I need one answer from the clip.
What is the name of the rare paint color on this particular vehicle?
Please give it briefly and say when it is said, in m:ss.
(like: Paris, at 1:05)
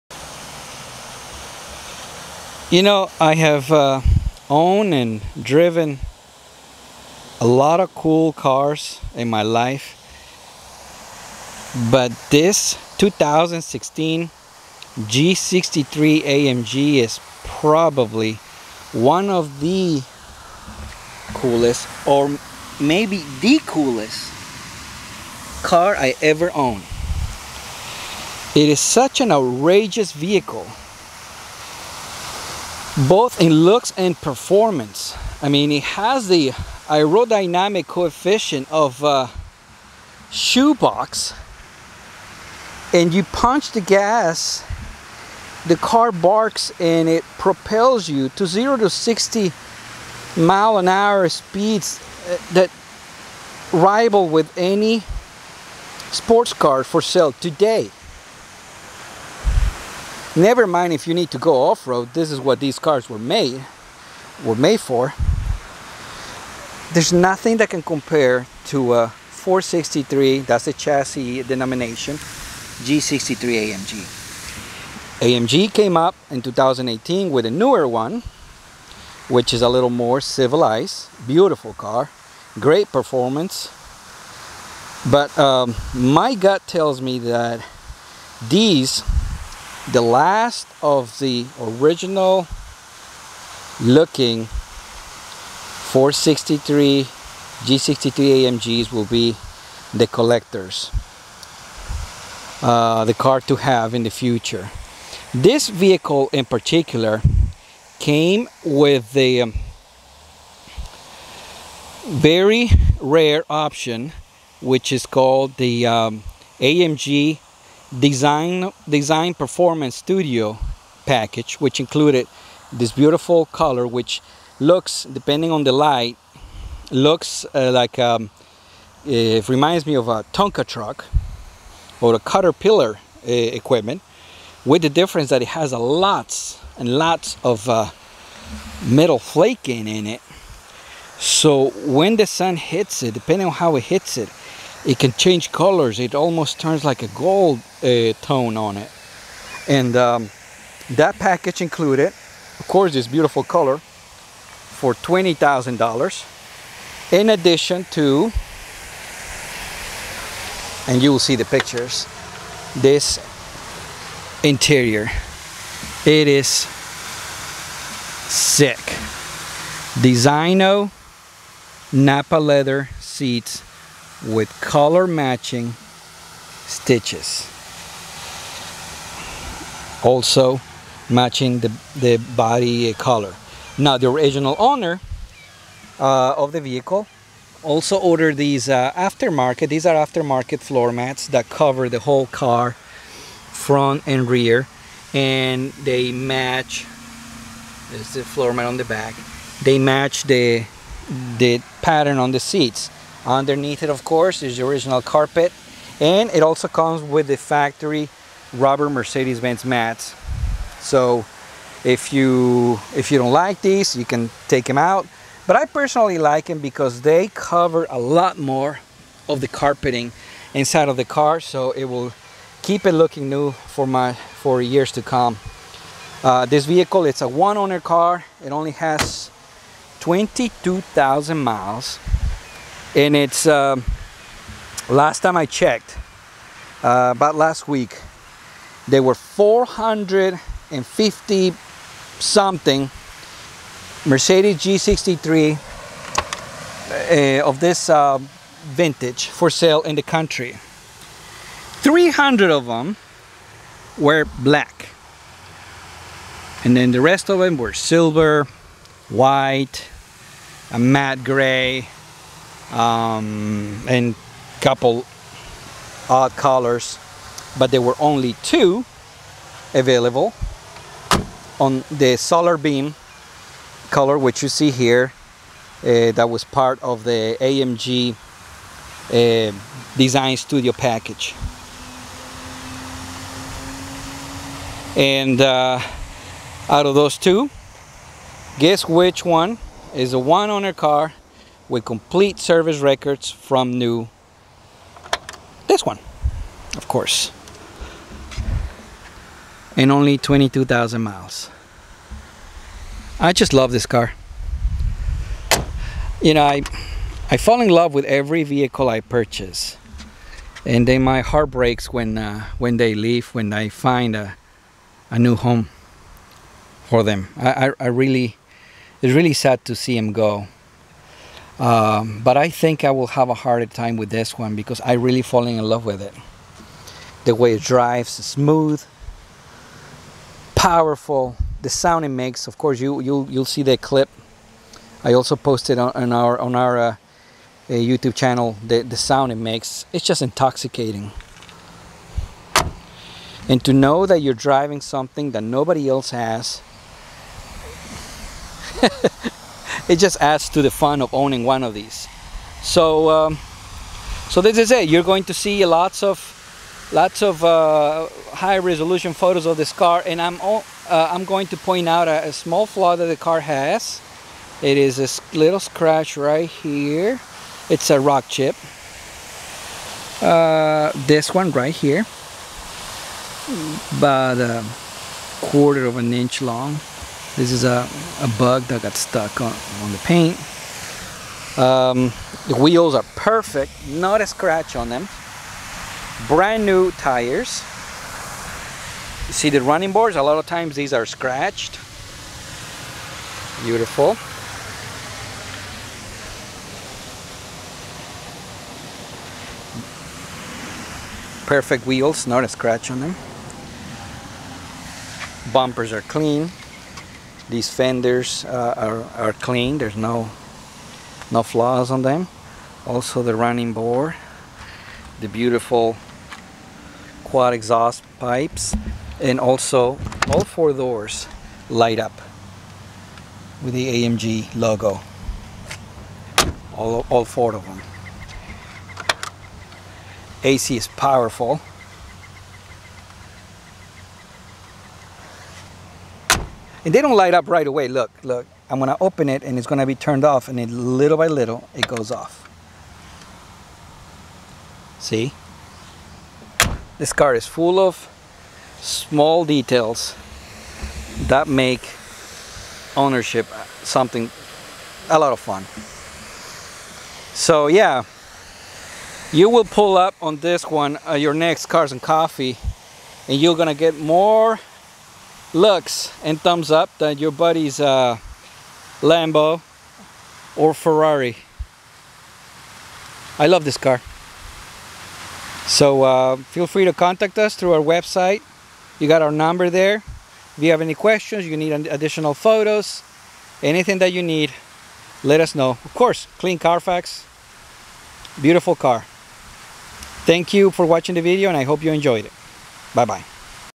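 Solarbeam, at 4:32.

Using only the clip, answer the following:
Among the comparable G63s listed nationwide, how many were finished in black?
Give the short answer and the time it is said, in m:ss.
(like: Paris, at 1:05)
300, at 4:11.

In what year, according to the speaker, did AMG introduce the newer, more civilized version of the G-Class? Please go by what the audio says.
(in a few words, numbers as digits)
2018.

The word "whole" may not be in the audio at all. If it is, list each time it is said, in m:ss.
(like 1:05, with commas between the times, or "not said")
3:11.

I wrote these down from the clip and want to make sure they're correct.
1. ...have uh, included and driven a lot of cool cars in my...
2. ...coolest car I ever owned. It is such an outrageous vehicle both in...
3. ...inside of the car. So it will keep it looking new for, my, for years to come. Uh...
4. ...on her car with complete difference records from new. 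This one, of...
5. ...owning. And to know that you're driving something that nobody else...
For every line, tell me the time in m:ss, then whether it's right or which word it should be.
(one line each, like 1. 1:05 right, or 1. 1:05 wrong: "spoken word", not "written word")
1. 0:03 wrong: "owned", not "included"
2. 0:23 right
3. 3:40 right
4. 4:50 wrong: "service", not "difference"
5. 5:40 wrong: "intoxicating", not "owning".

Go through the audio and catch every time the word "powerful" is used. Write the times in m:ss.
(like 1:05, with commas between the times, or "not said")
5:30, 7:10.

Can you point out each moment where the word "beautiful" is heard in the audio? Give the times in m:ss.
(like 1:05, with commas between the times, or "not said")
1:21, 2:02, 2:33, 6:33, 6:55, 8:08.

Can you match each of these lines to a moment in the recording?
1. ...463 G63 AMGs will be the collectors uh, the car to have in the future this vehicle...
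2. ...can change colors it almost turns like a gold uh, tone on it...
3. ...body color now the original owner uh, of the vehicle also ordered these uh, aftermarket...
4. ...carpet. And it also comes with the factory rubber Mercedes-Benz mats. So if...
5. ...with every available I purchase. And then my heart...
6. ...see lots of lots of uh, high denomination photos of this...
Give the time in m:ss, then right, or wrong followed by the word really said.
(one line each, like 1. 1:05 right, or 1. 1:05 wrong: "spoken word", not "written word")
1. 1:34 right
2. 2:24 right
3. 3:02 right
4. 3:25 right
5. 5:07 wrong: "vehicle", not "available"
6. 5:55 wrong: "resolution", not "denomination".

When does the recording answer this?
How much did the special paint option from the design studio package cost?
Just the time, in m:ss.
2:34.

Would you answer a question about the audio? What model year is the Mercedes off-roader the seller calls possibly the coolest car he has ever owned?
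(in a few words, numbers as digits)
2016.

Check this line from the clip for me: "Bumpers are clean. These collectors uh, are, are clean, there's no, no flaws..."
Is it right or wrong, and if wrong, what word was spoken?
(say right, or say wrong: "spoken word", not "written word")
wrong: "fenders", not "collectors".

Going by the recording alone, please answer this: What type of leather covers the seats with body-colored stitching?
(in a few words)
designo napa leather.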